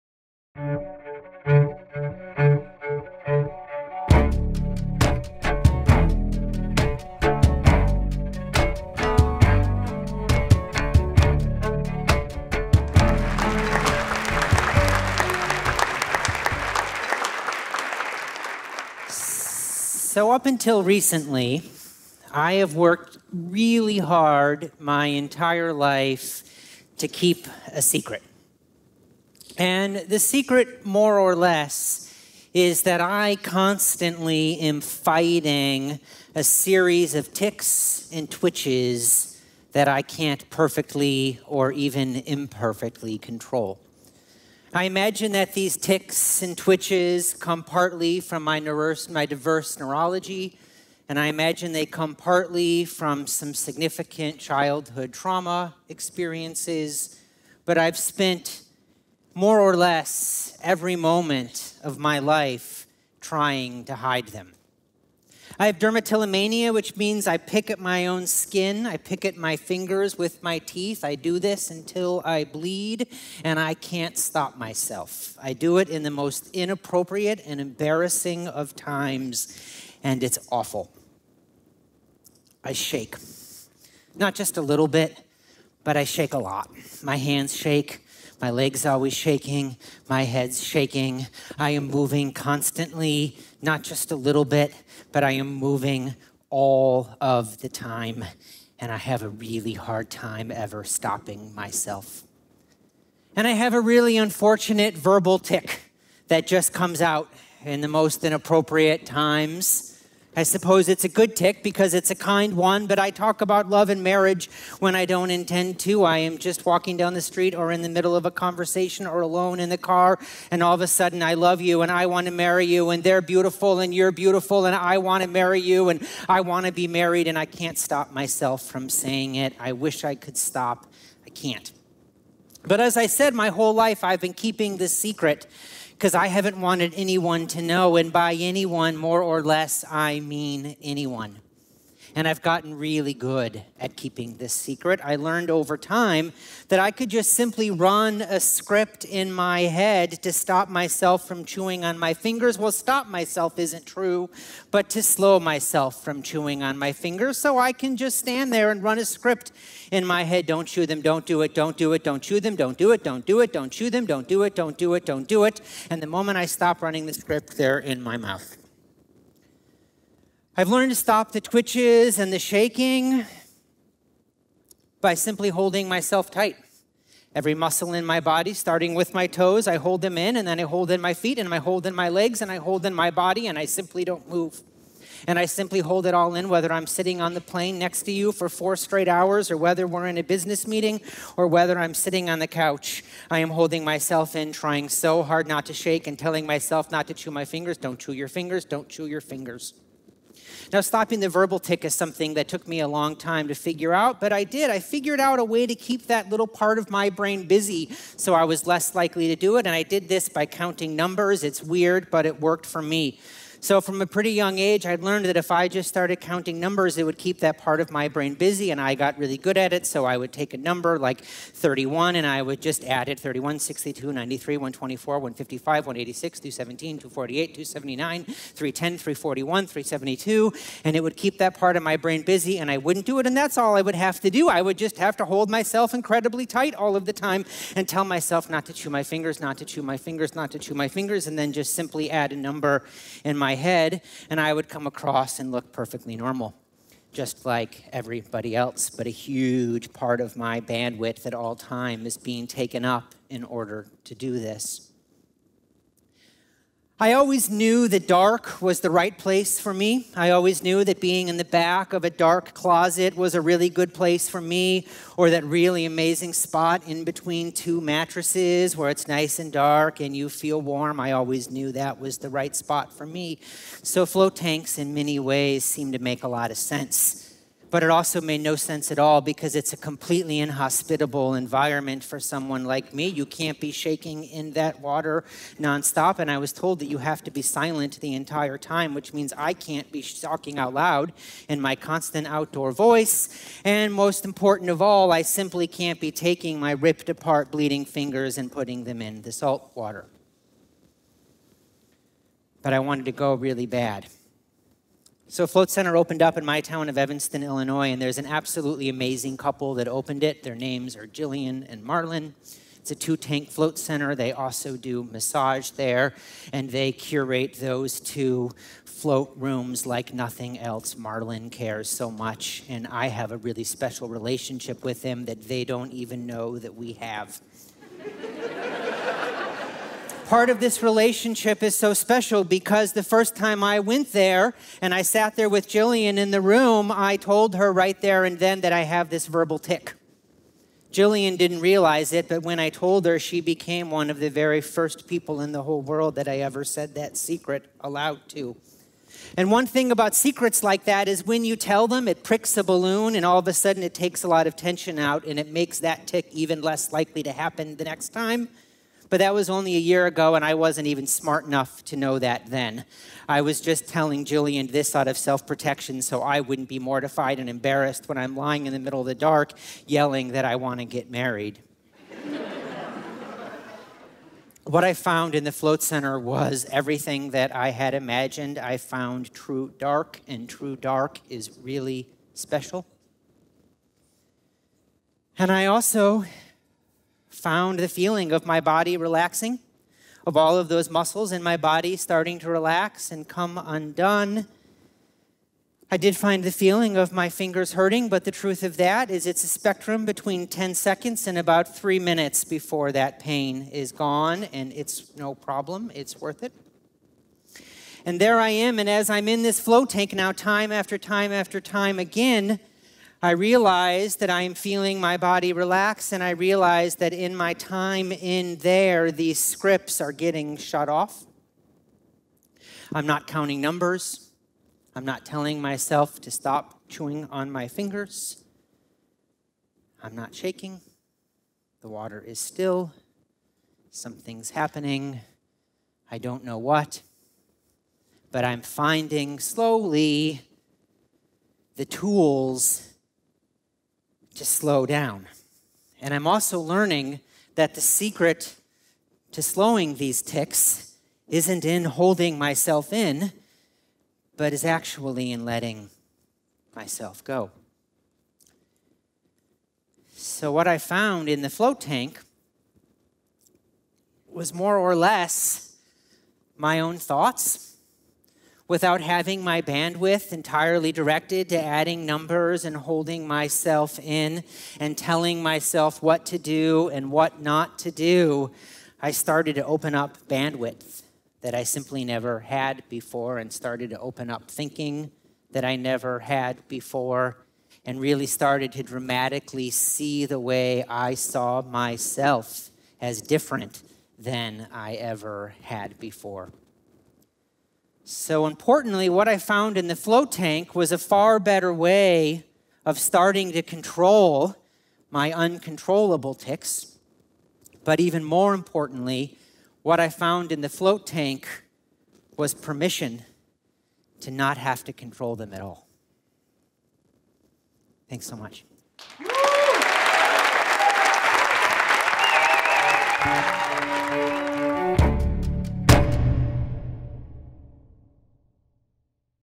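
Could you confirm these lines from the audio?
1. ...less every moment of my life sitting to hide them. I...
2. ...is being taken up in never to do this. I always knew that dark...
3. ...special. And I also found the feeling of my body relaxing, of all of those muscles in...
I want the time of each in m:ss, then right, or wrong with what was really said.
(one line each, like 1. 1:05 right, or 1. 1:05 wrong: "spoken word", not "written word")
1. 0:59 wrong: "trying", not "sitting"
2. 4:12 wrong: "order", not "never"
3. 6:22 right.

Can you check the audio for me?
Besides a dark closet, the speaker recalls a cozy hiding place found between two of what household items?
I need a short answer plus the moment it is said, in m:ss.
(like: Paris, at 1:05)
mattresses, at 4:27.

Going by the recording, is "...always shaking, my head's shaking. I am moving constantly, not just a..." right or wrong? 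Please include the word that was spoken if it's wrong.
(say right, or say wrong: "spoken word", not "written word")
right.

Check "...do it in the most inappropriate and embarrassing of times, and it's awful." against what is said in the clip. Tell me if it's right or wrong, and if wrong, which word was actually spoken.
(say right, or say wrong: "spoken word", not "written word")
right.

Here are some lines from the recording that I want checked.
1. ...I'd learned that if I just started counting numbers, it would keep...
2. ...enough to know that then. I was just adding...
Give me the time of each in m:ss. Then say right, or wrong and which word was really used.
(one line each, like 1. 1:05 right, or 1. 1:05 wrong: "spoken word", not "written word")
1. 3:34 right
2. 6:01 wrong: "telling", not "adding".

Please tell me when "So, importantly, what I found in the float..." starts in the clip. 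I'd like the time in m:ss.
8:18.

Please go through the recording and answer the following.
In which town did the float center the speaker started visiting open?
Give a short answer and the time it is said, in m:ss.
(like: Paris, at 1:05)
Evanston, Illinois, at 5:06.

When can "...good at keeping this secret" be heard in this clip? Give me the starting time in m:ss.
2:23.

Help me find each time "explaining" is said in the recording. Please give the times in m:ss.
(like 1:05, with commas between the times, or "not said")
not said.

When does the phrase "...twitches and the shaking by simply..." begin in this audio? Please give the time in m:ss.
2:51.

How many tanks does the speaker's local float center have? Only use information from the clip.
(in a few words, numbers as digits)
2.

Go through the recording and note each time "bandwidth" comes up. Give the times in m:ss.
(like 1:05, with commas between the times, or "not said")
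4:10, 7:49, 8:00.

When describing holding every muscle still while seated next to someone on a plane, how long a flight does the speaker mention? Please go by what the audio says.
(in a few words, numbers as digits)
4 hours.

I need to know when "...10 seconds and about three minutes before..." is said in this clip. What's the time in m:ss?
6:40.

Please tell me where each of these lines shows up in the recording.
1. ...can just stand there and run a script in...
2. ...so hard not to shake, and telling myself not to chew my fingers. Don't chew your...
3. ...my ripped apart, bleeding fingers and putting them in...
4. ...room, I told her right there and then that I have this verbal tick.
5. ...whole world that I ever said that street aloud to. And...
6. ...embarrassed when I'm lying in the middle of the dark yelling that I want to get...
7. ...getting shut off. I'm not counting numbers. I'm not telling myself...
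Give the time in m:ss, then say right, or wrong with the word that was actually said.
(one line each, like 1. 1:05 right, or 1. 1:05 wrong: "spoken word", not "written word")
1. 2:37 right
2. 3:14 right
3. 4:56 right
4. 5:36 right
5. 5:45 wrong: "secret", not "street"
6. 6:07 right
7. 7:00 right.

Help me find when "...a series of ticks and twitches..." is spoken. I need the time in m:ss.
0:36.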